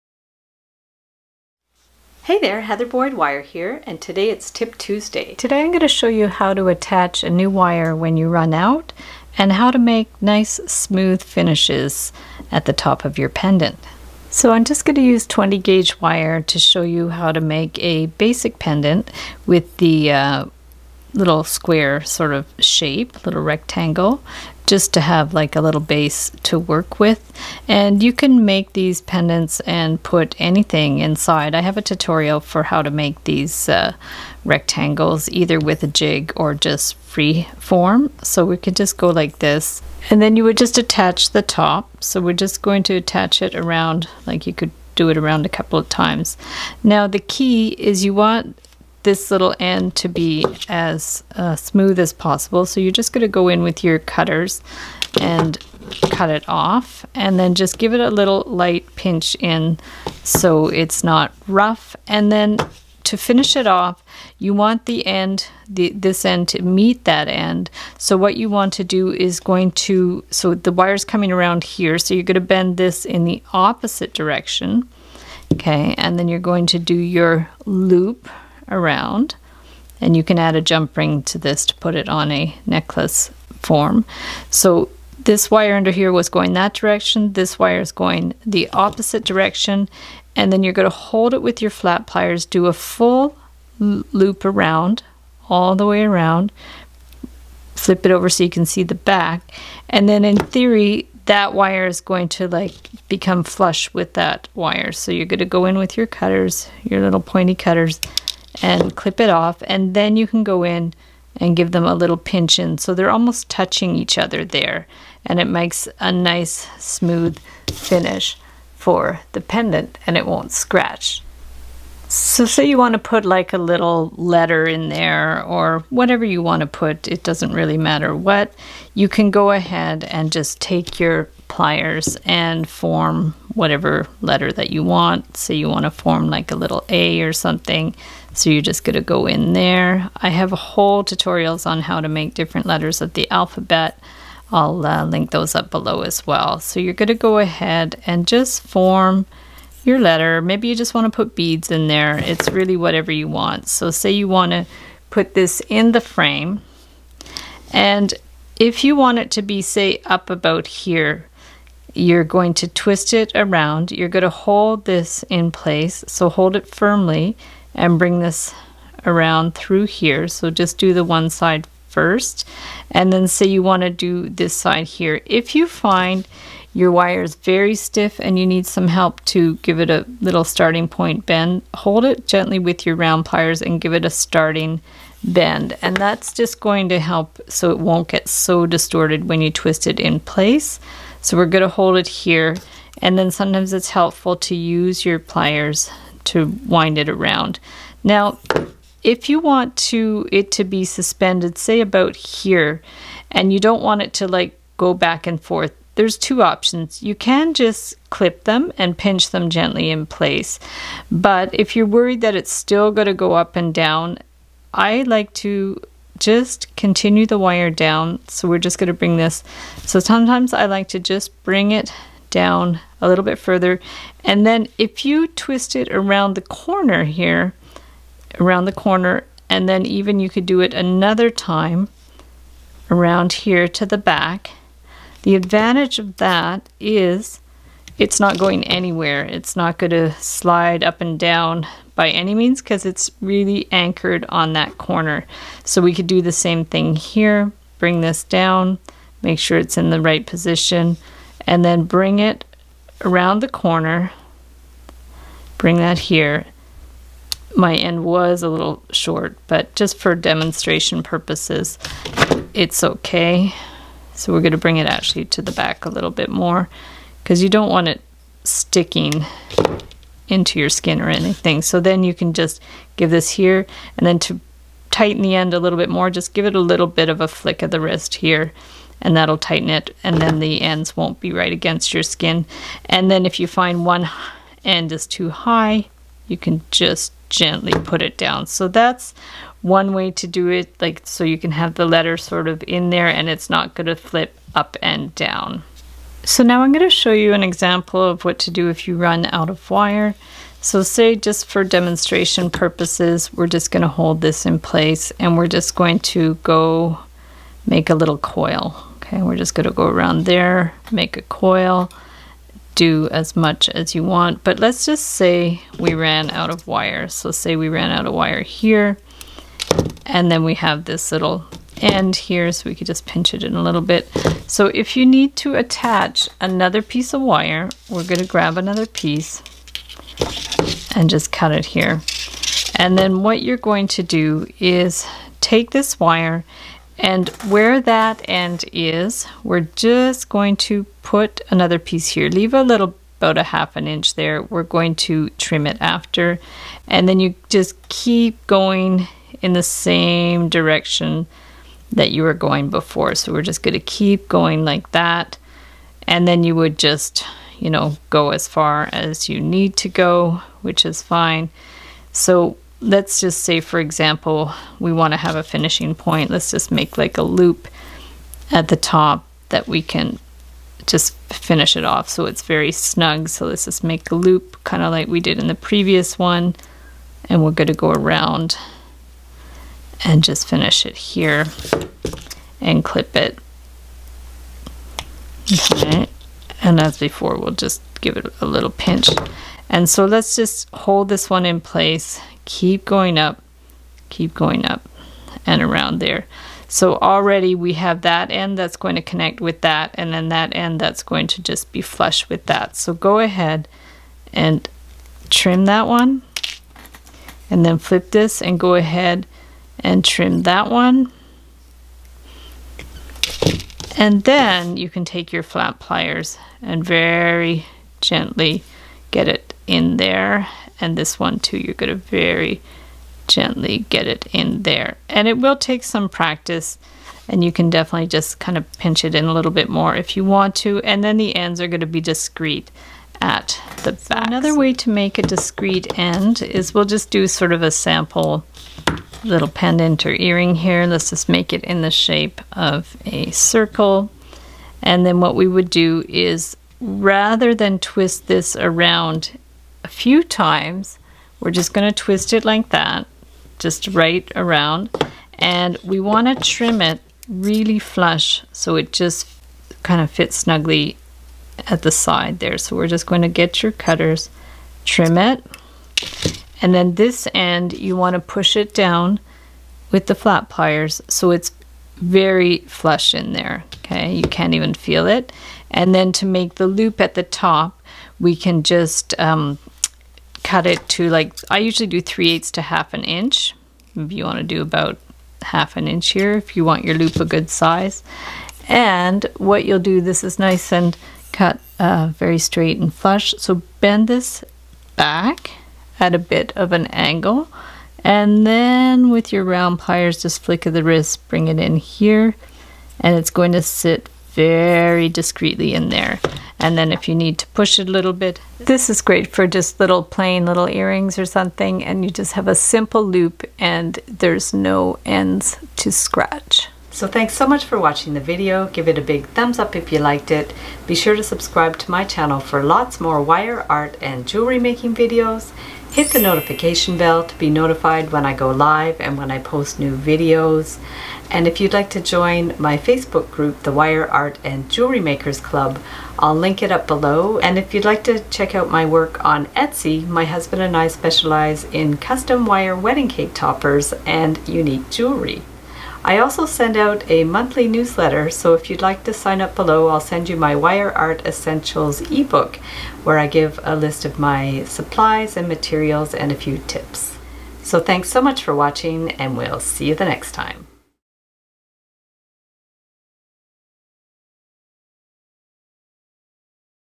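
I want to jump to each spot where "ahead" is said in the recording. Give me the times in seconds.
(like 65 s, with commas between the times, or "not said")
129 s, 147 s, 403 s, 408 s.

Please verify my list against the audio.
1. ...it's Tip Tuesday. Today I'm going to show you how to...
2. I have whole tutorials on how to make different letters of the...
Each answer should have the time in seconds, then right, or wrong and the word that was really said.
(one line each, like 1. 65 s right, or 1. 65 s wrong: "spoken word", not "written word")
1. 4 s right
2. 140 s right.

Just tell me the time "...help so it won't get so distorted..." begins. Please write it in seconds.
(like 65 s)
186 s.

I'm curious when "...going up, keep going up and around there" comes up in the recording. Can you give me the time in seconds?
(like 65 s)
392 s.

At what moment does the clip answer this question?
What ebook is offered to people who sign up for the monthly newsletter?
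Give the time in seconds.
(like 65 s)
550 s.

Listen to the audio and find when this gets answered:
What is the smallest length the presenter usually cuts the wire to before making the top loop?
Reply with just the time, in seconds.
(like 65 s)
482 s.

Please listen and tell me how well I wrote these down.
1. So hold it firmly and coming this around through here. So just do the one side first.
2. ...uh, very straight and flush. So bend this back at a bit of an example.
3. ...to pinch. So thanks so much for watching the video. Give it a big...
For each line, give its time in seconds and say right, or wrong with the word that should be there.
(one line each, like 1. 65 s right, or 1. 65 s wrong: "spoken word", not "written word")
1. 166 s wrong: "bring", not "coming"
2. 491 s wrong: "angle", not "example"
3. 515 s wrong: "scratch", not "pinch".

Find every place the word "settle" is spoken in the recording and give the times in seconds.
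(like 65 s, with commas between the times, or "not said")
not said.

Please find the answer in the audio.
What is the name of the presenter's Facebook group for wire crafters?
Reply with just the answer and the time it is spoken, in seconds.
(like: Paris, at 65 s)
Wire Art and Jewelry Makers Club, at 533 s.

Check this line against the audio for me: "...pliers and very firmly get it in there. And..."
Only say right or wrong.
wrong.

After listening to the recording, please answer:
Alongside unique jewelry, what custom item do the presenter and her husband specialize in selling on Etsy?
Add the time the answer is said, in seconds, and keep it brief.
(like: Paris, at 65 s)
wire wedding cake toppers, at 542 s.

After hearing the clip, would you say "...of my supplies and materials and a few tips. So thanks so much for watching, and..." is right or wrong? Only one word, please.
right.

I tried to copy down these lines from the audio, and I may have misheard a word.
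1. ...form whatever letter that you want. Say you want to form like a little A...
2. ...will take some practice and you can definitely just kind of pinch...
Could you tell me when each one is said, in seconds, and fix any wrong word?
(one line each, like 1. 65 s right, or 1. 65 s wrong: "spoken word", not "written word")
1. 132 s right
2. 425 s right.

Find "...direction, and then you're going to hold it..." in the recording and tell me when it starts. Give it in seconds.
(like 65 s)
89 s.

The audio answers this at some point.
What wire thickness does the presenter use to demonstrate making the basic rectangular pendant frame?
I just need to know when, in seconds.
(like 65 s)
15 s.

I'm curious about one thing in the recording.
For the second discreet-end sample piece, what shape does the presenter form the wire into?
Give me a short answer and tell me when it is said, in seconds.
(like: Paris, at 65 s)
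circle, at 443 s.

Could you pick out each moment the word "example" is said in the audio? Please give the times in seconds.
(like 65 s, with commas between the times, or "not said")
297 s, 363 s.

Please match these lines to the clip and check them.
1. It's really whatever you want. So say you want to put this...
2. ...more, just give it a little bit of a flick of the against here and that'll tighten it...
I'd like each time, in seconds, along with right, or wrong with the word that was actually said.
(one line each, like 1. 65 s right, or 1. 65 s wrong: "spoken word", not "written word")
1. 152 s right
2. 275 s wrong: "wrist", not "against".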